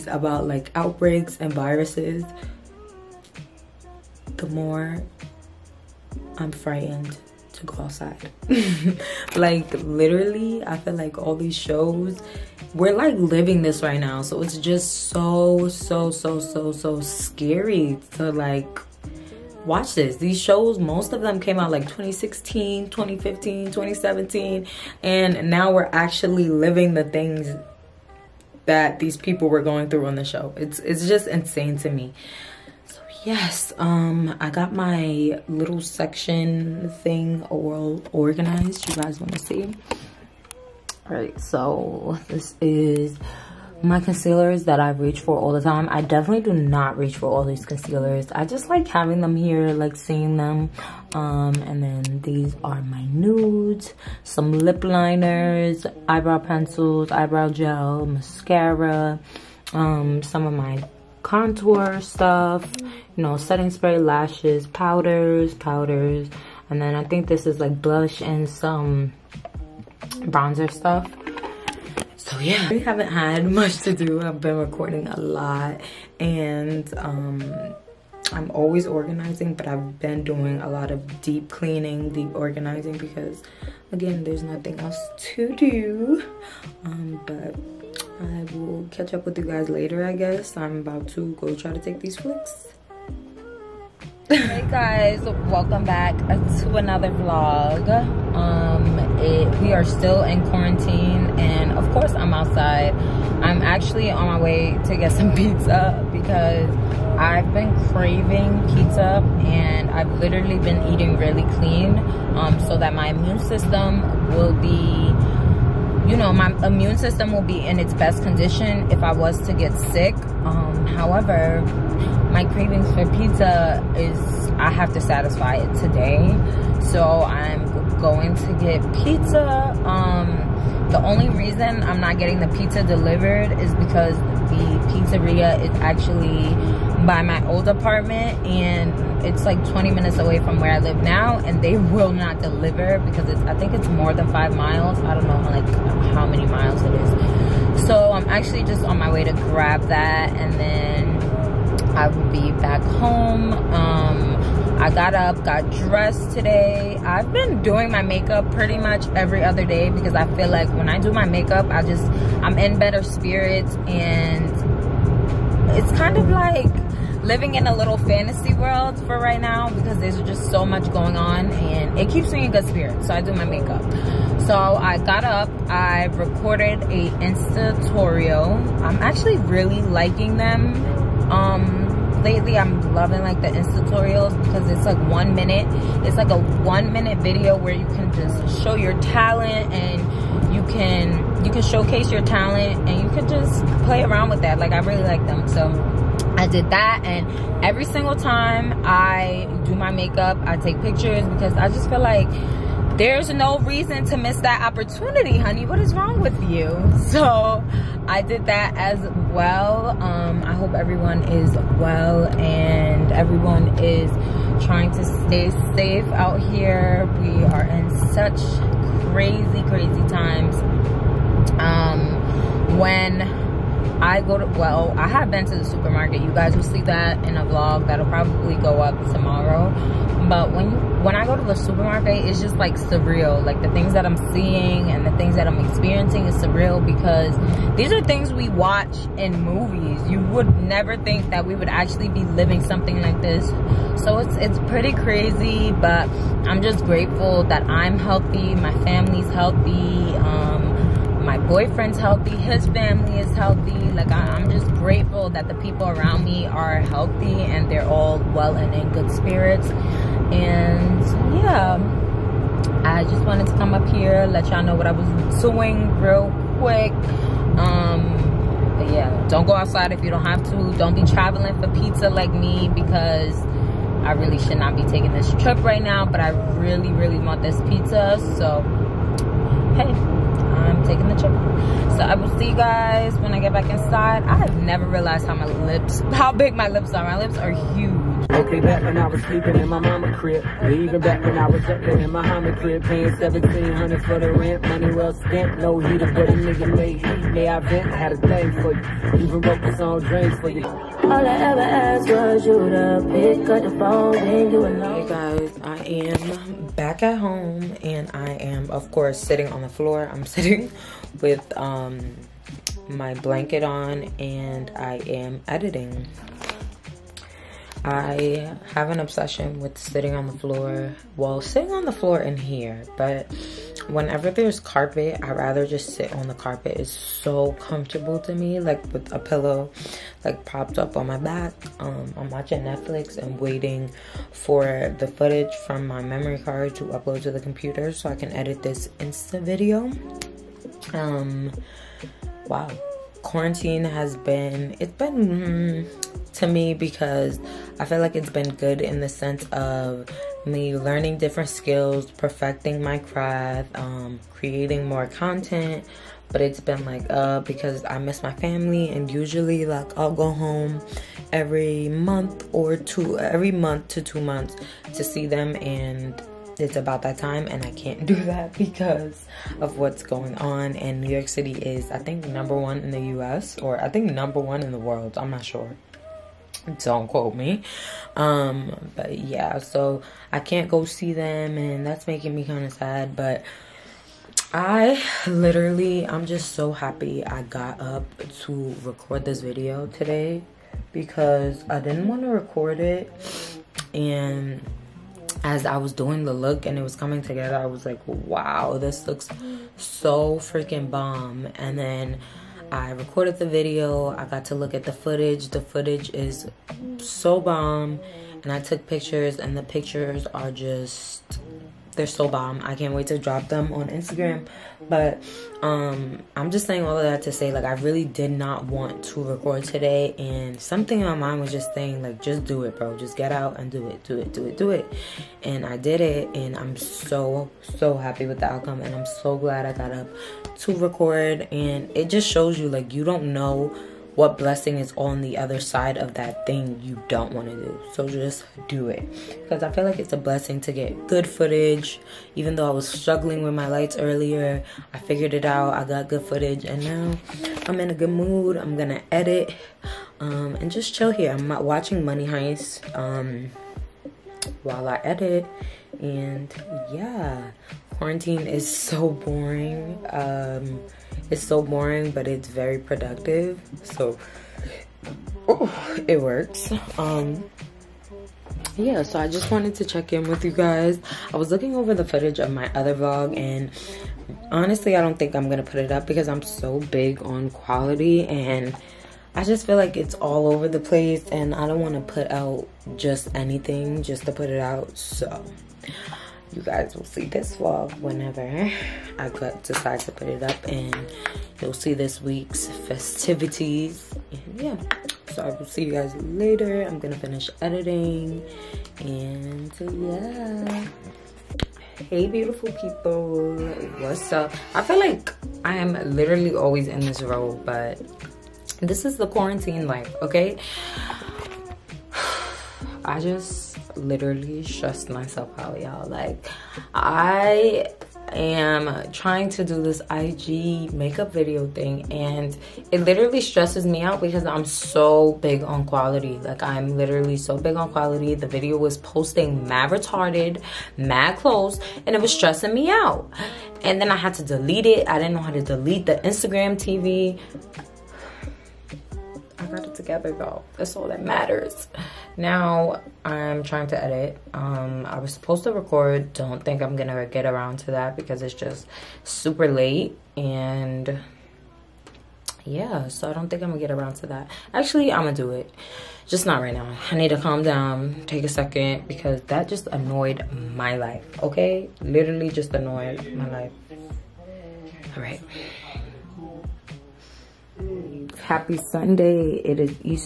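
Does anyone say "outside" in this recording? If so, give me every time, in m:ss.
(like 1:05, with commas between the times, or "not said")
0:07, 1:42, 4:29.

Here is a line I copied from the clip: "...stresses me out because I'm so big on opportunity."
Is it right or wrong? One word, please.
wrong.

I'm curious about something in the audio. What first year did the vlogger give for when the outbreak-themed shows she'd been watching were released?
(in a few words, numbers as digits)
2016.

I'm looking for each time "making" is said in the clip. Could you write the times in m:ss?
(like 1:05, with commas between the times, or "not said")
6:22.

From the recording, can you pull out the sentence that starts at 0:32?
So yes, um I got my little section thing all organized.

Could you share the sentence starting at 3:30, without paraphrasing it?
Um, I hope everyone is well and everyone is trying to stay safe out here.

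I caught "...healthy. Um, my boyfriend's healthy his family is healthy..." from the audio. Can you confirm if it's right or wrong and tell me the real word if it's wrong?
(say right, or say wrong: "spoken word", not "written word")
right.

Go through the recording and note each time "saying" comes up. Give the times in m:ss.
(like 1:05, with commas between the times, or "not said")
6:56, 7:01.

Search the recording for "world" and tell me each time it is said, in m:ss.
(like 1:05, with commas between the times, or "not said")
2:48, 6:14.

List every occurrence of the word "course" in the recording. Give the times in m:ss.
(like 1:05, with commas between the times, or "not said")
1:41, 5:08.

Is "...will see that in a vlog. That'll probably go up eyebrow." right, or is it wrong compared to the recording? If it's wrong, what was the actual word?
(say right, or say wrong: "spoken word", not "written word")
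wrong: "tomorrow", not "eyebrow".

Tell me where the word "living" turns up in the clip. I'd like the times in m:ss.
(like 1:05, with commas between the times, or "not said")
0:13, 0:26, 2:47, 4:02.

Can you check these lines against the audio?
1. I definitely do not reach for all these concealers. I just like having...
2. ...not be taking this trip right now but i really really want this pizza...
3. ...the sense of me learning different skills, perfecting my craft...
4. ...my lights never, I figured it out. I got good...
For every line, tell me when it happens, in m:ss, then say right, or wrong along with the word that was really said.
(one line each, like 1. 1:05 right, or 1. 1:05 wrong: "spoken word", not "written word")
1. 0:45 right
2. 4:34 right
3. 5:48 right
4. 7:23 wrong: "earlier", not "never".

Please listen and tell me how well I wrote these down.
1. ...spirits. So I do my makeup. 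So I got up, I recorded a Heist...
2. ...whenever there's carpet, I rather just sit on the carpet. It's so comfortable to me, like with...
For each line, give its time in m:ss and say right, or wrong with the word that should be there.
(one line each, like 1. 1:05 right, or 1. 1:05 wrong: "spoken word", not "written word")
1. 2:52 wrong: "Insta", not "Heist"
2. 5:23 right.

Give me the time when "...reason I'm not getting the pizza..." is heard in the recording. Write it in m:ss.
2:11.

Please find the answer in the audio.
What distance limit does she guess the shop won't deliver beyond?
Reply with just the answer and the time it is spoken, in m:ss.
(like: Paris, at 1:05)
Five miles, at 2:24.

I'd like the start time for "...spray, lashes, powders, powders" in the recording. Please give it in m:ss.
1:03.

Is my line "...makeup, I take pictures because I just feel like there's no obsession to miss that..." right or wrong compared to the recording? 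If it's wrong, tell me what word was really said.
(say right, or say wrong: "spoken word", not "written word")
wrong: "reason", not "obsession".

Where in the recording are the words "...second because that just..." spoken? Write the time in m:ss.
9:18.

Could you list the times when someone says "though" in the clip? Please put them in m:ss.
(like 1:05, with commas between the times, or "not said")
7:22, 9:00.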